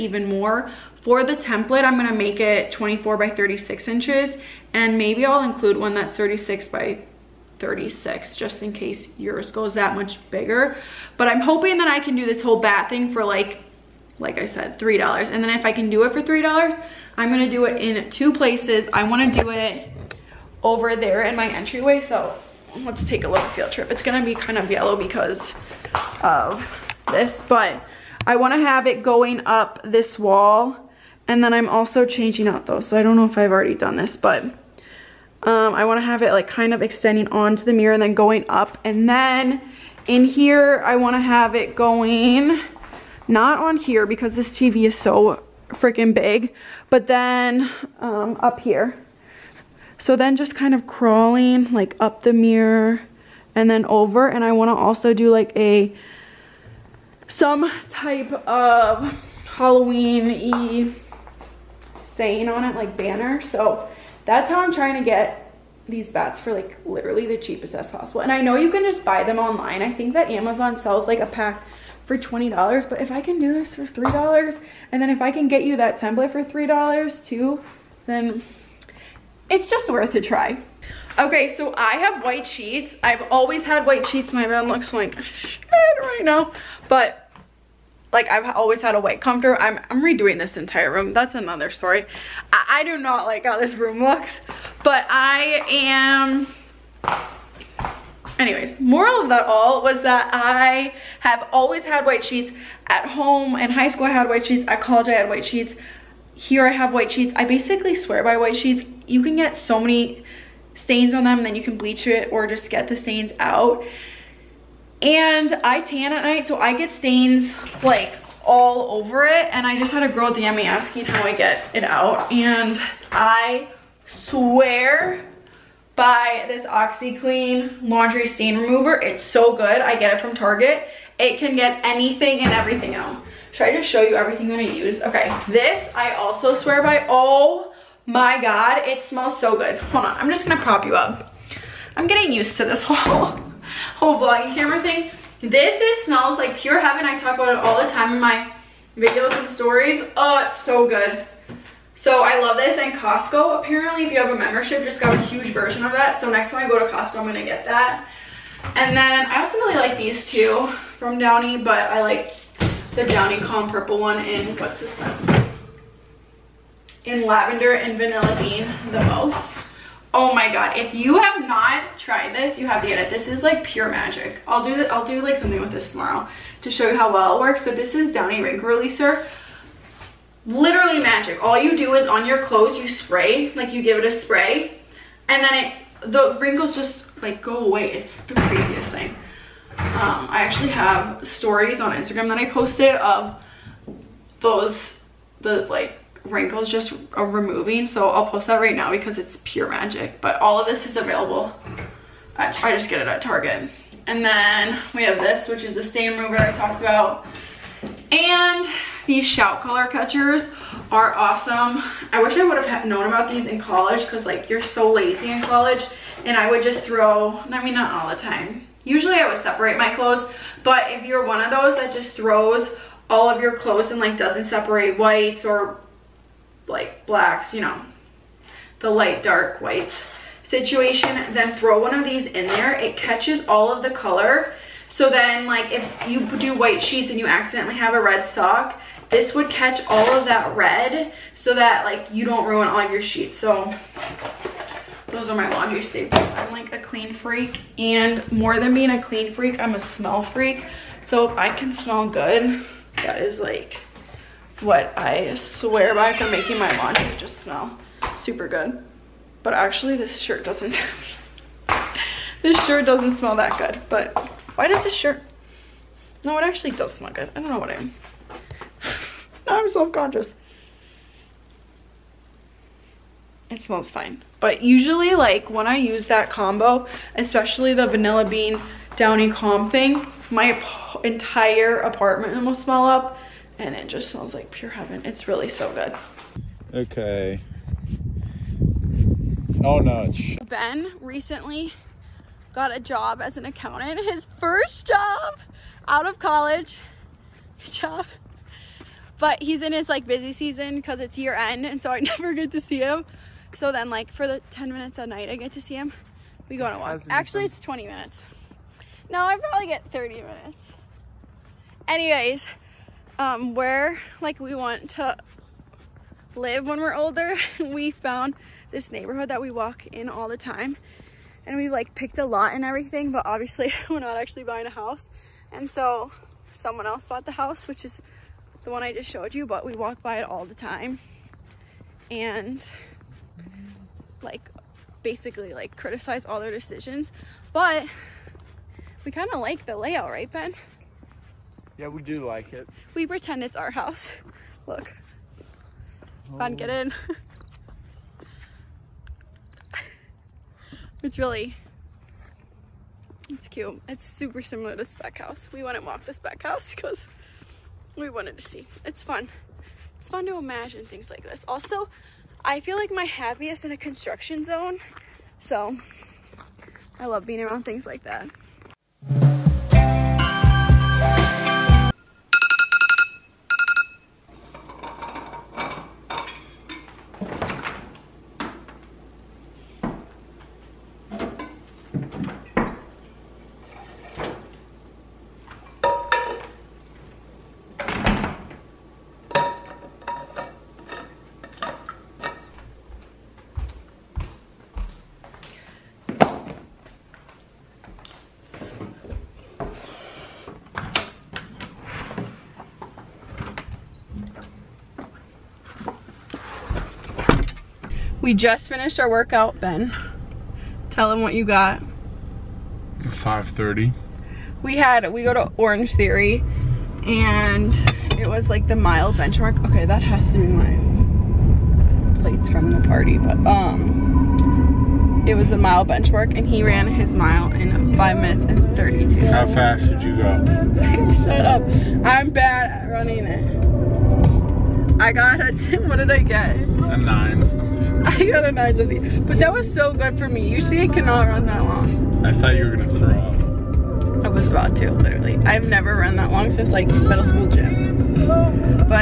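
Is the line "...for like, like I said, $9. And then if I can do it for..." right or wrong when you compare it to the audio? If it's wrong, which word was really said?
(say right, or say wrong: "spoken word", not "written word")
wrong: "3", not "9".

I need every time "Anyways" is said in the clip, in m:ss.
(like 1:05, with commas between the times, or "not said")
1:38, 5:11.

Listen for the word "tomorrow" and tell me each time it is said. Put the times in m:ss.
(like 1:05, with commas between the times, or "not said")
2:55.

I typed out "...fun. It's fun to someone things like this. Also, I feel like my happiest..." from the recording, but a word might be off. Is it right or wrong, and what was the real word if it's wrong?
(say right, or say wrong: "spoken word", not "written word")
wrong: "imagine", not "someone".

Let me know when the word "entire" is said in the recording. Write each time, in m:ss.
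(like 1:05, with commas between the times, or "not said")
1:30, 4:41.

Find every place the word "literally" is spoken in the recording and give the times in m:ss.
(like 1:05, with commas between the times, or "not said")
1:06, 3:00, 7:24.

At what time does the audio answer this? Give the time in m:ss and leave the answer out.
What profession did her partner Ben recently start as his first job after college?
4:53.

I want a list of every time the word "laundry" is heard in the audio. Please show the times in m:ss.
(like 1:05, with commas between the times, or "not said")
2:07, 4:05, 4:16.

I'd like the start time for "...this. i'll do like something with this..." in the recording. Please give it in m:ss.
2:54.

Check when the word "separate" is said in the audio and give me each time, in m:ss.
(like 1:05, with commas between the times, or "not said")
3:39, 3:44.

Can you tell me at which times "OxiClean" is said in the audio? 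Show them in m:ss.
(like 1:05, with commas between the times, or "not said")
2:06.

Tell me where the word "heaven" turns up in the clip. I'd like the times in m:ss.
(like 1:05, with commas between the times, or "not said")
2:26, 4:44.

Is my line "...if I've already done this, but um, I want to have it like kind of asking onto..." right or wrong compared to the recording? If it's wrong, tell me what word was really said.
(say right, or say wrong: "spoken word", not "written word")
wrong: "extending", not "asking".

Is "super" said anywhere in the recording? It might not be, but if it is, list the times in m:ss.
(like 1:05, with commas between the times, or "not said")
4:18, 5:54.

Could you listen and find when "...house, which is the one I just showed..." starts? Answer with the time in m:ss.
5:27.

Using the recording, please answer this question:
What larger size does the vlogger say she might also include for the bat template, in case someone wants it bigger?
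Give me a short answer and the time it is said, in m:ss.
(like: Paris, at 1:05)
36 by 36 inches, at 0:06.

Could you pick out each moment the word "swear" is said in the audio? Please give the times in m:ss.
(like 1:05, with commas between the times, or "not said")
1:47, 2:04, 2:16, 4:15.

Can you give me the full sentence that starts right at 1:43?
In high school, I had white sheets.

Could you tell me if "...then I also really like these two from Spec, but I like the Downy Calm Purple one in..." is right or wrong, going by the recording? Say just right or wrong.
wrong.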